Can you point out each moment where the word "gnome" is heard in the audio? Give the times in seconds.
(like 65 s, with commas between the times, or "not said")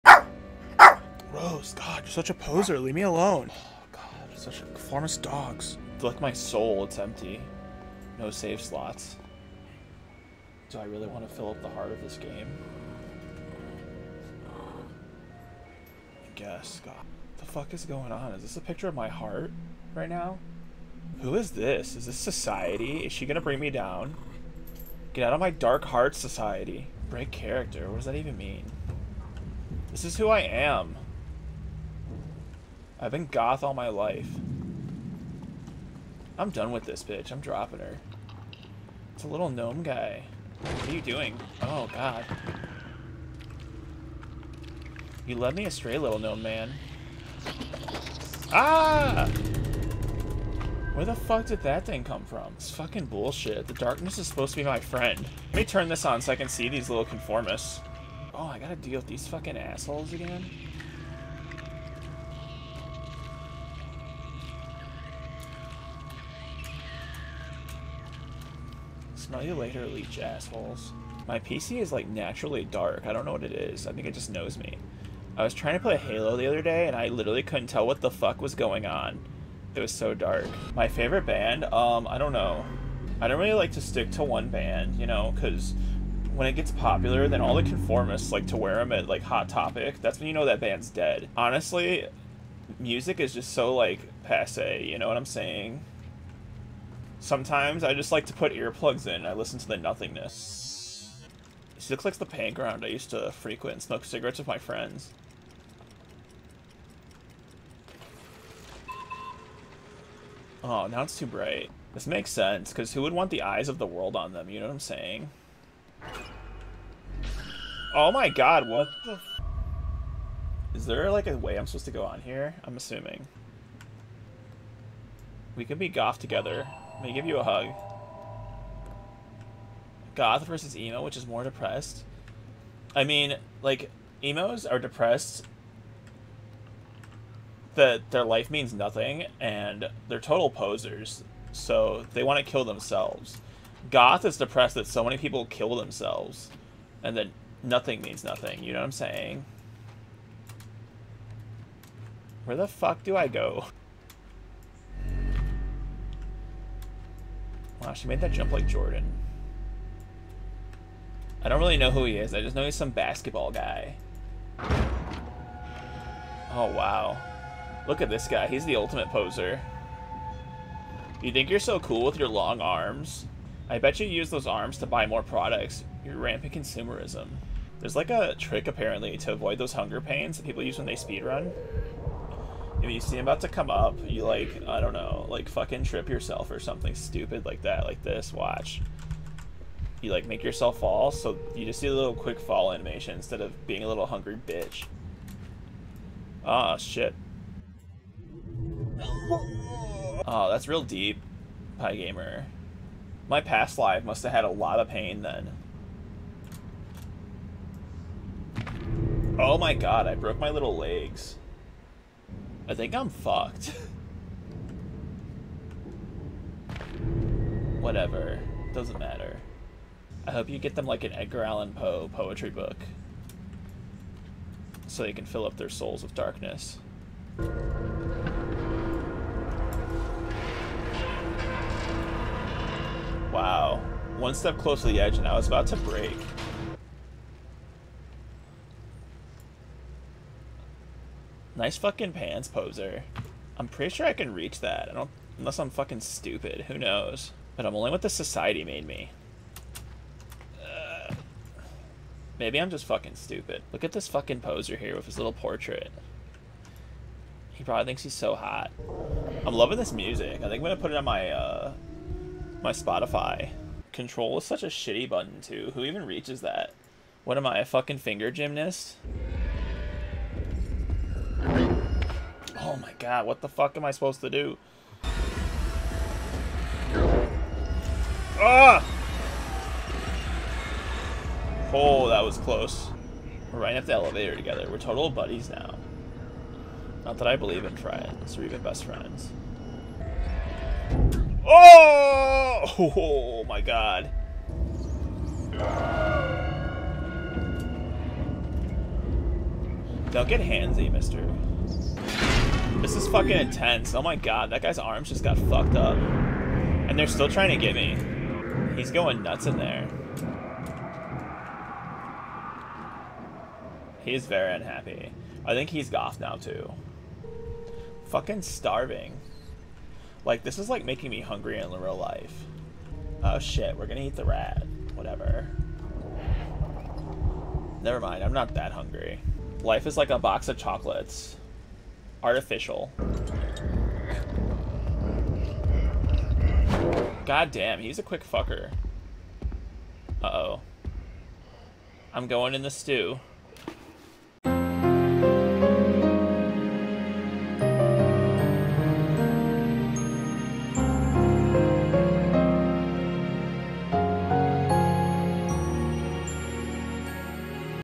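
39 s, 46 s.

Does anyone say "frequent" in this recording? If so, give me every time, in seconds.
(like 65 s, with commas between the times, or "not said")
103 s.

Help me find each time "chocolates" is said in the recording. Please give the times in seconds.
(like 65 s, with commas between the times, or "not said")
330 s.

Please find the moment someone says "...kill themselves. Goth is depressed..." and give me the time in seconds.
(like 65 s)
142 s.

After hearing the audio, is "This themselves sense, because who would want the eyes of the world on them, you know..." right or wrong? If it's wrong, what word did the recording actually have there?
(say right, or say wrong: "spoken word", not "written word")
wrong: "makes", not "themselves".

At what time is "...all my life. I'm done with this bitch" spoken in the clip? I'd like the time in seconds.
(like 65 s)
33 s.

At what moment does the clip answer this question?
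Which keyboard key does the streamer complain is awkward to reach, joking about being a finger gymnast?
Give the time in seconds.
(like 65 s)
263 s.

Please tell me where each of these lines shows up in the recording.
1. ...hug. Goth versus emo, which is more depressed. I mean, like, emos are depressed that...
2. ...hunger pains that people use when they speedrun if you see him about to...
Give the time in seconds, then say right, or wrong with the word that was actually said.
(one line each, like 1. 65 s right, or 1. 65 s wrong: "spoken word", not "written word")
1. 127 s right
2. 179 s right.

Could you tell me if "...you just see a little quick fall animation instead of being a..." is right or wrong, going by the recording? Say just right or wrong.
right.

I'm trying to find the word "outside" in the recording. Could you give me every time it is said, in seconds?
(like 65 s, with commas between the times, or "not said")
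not said.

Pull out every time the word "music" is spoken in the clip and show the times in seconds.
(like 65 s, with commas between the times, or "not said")
92 s, 259 s.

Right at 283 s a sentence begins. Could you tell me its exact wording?
We're riding up the elevator together.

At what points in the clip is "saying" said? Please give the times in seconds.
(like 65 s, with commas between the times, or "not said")
95 s, 114 s, 148 s.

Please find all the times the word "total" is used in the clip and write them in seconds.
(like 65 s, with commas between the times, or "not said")
140 s, 284 s.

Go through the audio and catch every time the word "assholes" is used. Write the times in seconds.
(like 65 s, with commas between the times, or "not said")
59 s, 70 s.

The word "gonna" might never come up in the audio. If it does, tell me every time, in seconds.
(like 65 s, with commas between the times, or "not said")
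23 s, 260 s, 323 s.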